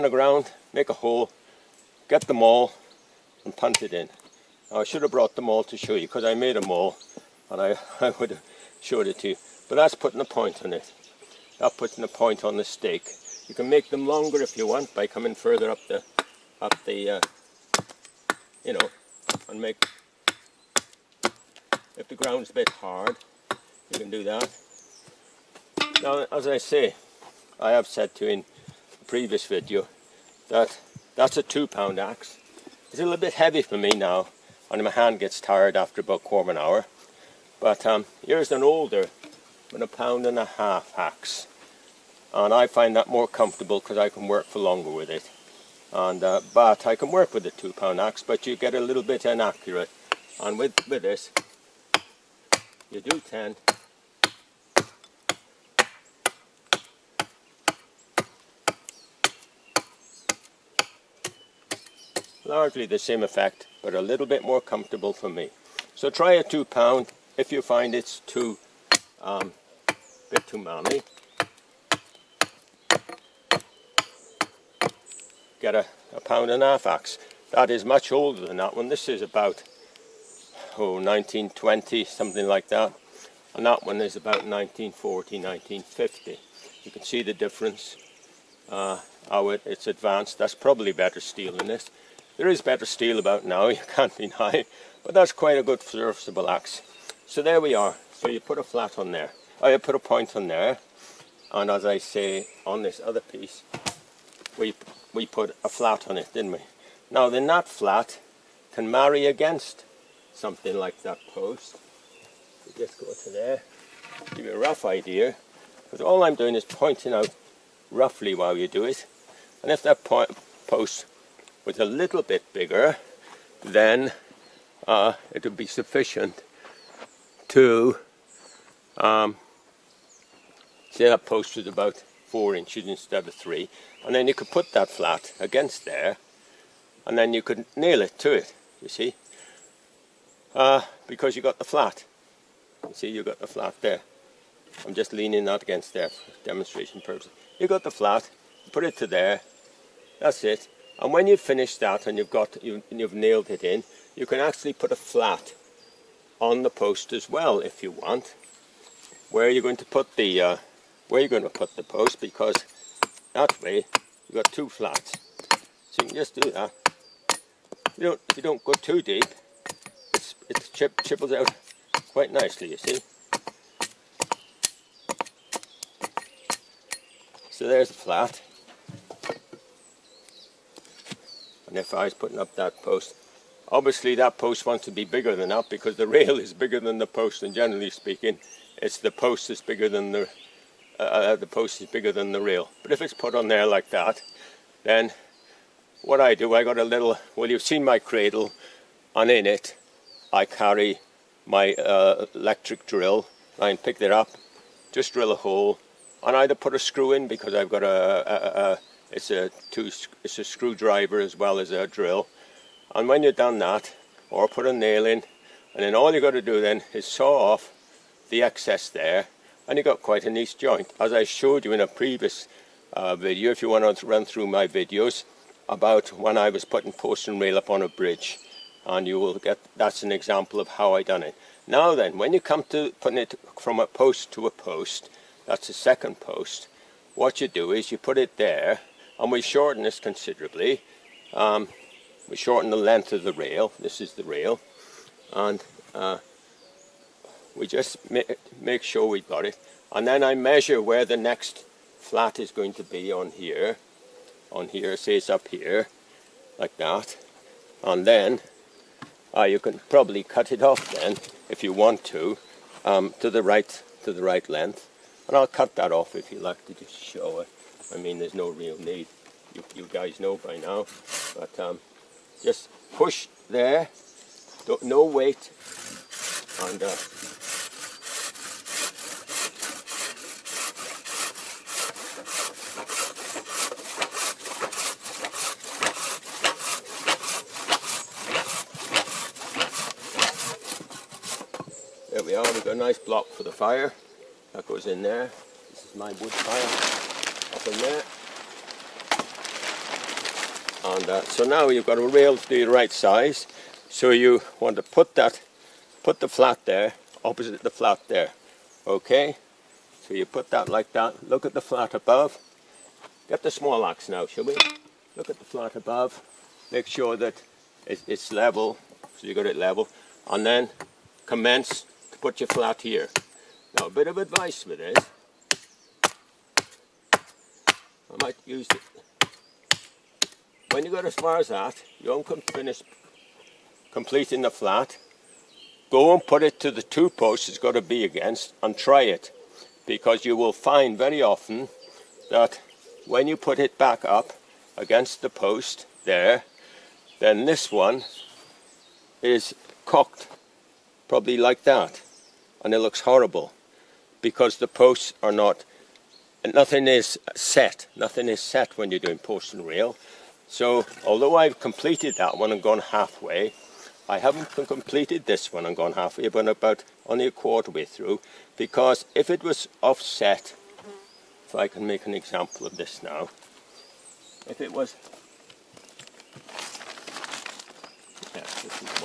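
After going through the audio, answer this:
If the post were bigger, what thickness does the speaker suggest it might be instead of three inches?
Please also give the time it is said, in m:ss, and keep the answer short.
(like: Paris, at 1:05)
4 inches, at 2:12.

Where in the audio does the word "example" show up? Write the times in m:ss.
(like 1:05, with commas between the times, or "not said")
3:50, 6:12.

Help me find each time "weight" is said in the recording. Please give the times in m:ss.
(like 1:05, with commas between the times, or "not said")
4:35.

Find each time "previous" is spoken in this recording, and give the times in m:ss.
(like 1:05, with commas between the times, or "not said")
0:29, 3:41.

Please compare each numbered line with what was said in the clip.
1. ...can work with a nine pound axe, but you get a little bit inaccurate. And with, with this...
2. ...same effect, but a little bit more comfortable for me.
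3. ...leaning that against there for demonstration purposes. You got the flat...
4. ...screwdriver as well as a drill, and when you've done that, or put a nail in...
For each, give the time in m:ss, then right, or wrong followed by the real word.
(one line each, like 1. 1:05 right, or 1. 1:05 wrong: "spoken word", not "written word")
1. 0:46 wrong: "two", not "nine"
2. 1:02 right
3. 2:25 right
4. 3:30 right.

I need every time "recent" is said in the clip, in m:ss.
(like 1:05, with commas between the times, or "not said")
not said.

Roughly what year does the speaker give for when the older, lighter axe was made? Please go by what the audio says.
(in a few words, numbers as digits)
1920.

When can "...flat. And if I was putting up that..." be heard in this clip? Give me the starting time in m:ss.
2:57.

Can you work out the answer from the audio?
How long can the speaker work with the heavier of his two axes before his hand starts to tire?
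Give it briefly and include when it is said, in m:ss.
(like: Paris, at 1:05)
quarter of an hour, at 0:36.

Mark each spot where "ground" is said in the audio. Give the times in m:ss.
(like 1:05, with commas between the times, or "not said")
0:00, 0:22.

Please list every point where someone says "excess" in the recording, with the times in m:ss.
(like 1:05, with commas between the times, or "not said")
3:38.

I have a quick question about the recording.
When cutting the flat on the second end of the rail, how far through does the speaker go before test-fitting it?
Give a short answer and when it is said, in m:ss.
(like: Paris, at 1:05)
a quarter way, at 6:07.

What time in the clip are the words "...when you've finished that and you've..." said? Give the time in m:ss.
2:31.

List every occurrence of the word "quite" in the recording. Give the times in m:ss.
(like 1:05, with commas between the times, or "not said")
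1:35, 2:52, 3:40.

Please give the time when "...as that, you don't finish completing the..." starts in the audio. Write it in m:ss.
5:31.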